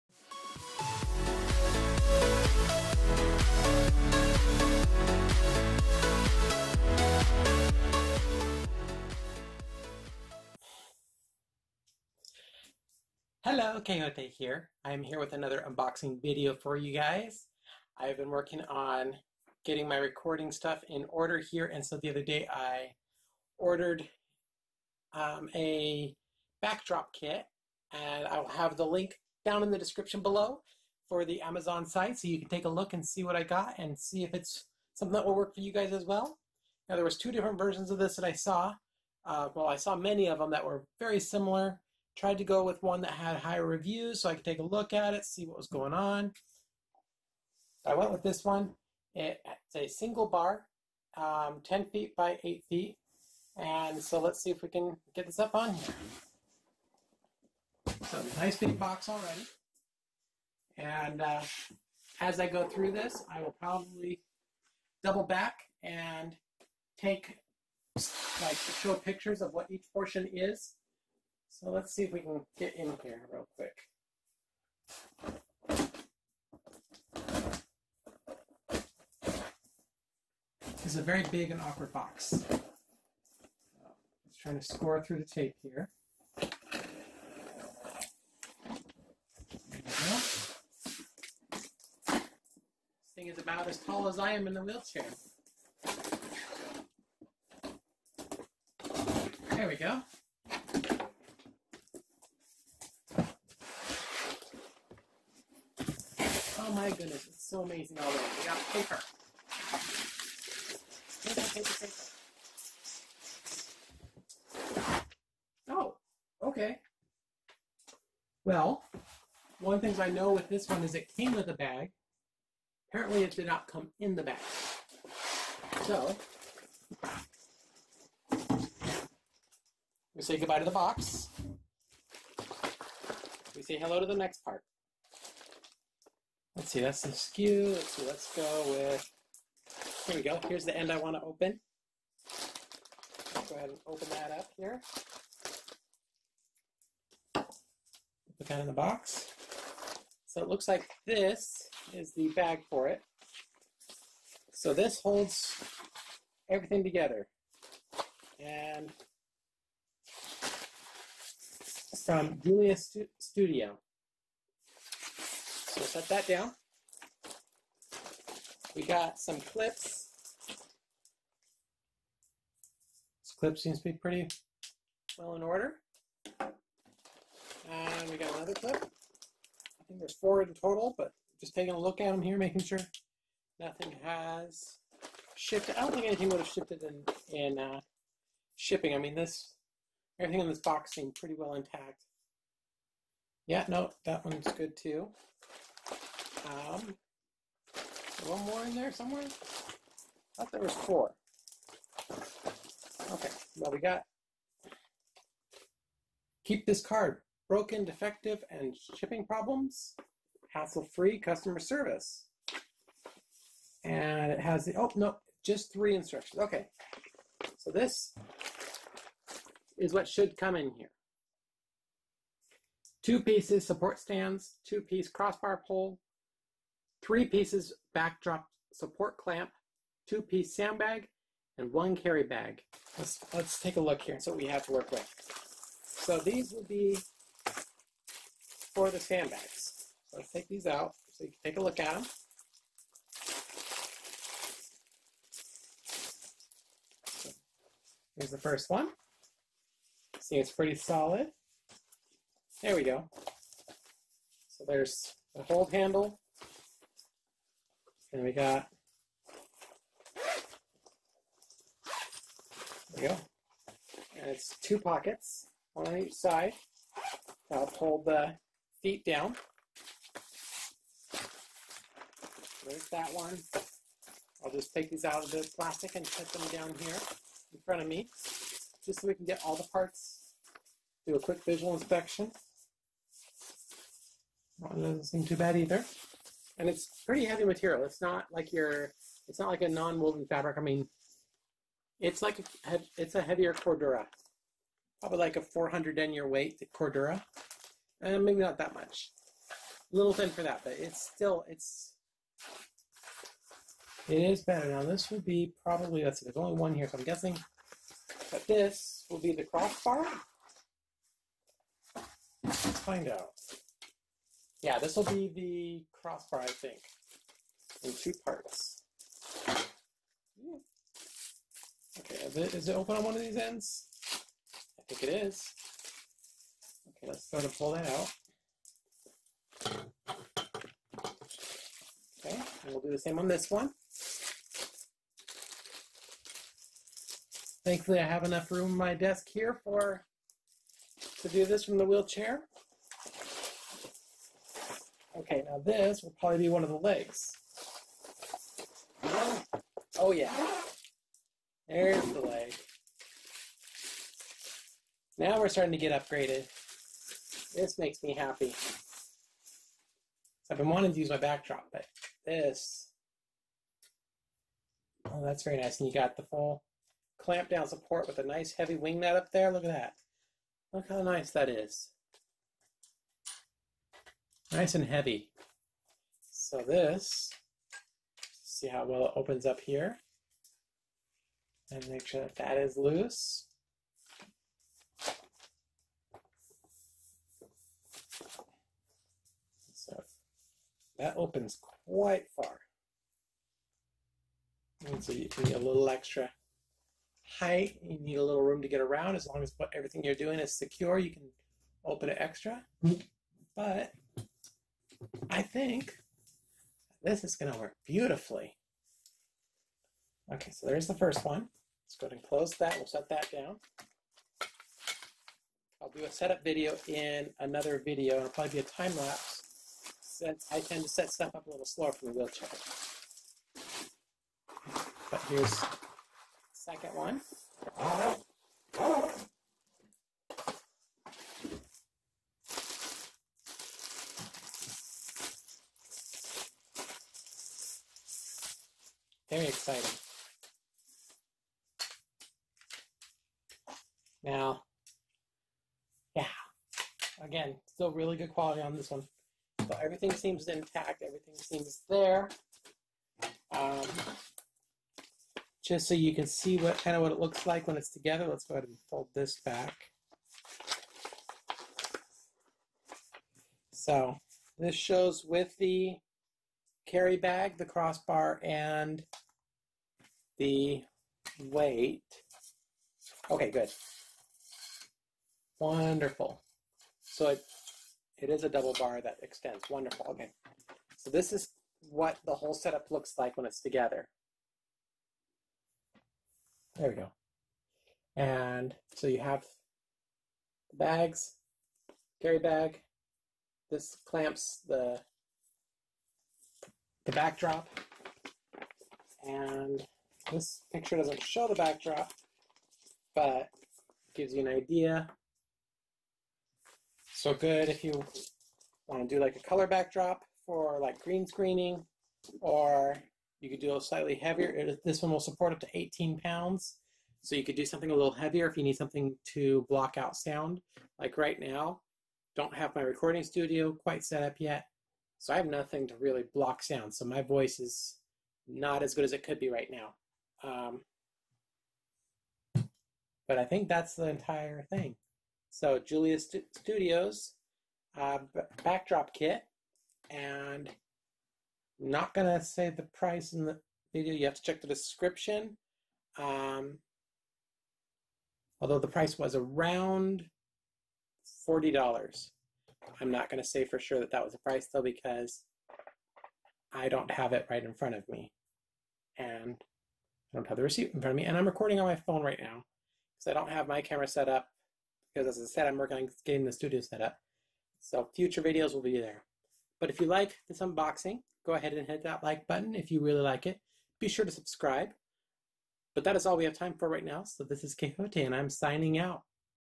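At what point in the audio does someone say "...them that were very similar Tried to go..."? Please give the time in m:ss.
0:40.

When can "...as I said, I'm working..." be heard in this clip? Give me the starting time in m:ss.
9:25.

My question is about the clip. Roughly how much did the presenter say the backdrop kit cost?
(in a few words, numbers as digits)
$40.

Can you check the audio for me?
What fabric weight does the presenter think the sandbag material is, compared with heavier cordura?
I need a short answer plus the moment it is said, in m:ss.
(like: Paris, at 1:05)
400 denier, at 4:55.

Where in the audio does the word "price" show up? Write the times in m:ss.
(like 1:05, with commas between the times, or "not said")
9:02, 9:08, 9:14.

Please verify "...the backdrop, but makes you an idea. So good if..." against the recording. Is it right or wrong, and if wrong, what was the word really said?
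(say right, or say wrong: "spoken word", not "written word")
wrong: "gives", not "makes".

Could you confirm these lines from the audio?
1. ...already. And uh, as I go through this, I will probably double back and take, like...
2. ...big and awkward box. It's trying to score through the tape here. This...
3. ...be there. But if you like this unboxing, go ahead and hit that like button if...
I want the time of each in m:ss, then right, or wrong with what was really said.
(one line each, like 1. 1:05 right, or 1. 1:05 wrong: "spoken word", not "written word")
1. 0:59 right
2. 1:21 right
3. 9:28 right.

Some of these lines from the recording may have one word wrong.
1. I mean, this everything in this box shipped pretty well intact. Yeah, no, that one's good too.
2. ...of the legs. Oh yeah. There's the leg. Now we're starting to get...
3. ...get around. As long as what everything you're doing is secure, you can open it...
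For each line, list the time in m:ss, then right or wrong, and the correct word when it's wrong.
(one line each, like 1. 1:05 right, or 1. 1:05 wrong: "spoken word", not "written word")
1. 3:08 wrong: "seemed", not "shipped"
2. 5:46 right
3. 6:38 right.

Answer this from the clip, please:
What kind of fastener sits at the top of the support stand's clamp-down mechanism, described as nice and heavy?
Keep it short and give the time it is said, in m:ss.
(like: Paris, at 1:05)
wing nut, at 6:08.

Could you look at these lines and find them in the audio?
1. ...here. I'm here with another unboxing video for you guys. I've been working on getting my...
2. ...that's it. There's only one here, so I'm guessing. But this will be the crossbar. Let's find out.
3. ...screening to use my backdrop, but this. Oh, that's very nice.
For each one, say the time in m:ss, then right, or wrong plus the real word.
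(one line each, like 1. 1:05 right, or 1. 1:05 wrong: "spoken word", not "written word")
1. 0:14 right
2. 5:06 right
3. 6:00 wrong: "wanting", not "screening".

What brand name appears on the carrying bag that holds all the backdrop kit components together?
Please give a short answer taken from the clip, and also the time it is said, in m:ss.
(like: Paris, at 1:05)
Julius Studio, at 2:42.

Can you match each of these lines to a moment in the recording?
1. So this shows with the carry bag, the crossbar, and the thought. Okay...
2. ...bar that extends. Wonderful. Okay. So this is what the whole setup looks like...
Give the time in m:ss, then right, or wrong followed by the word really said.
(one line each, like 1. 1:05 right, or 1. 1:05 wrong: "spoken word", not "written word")
1. 7:43 wrong: "weight", not "thought"
2. 7:58 right.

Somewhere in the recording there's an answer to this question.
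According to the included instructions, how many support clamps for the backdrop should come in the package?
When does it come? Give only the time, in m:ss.
3:47.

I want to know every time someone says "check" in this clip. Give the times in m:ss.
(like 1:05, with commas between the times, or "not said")
9:04.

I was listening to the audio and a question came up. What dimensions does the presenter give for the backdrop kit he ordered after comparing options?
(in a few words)
10 feet by 8 feet.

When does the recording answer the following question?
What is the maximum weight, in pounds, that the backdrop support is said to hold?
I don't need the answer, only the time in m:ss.
8:35.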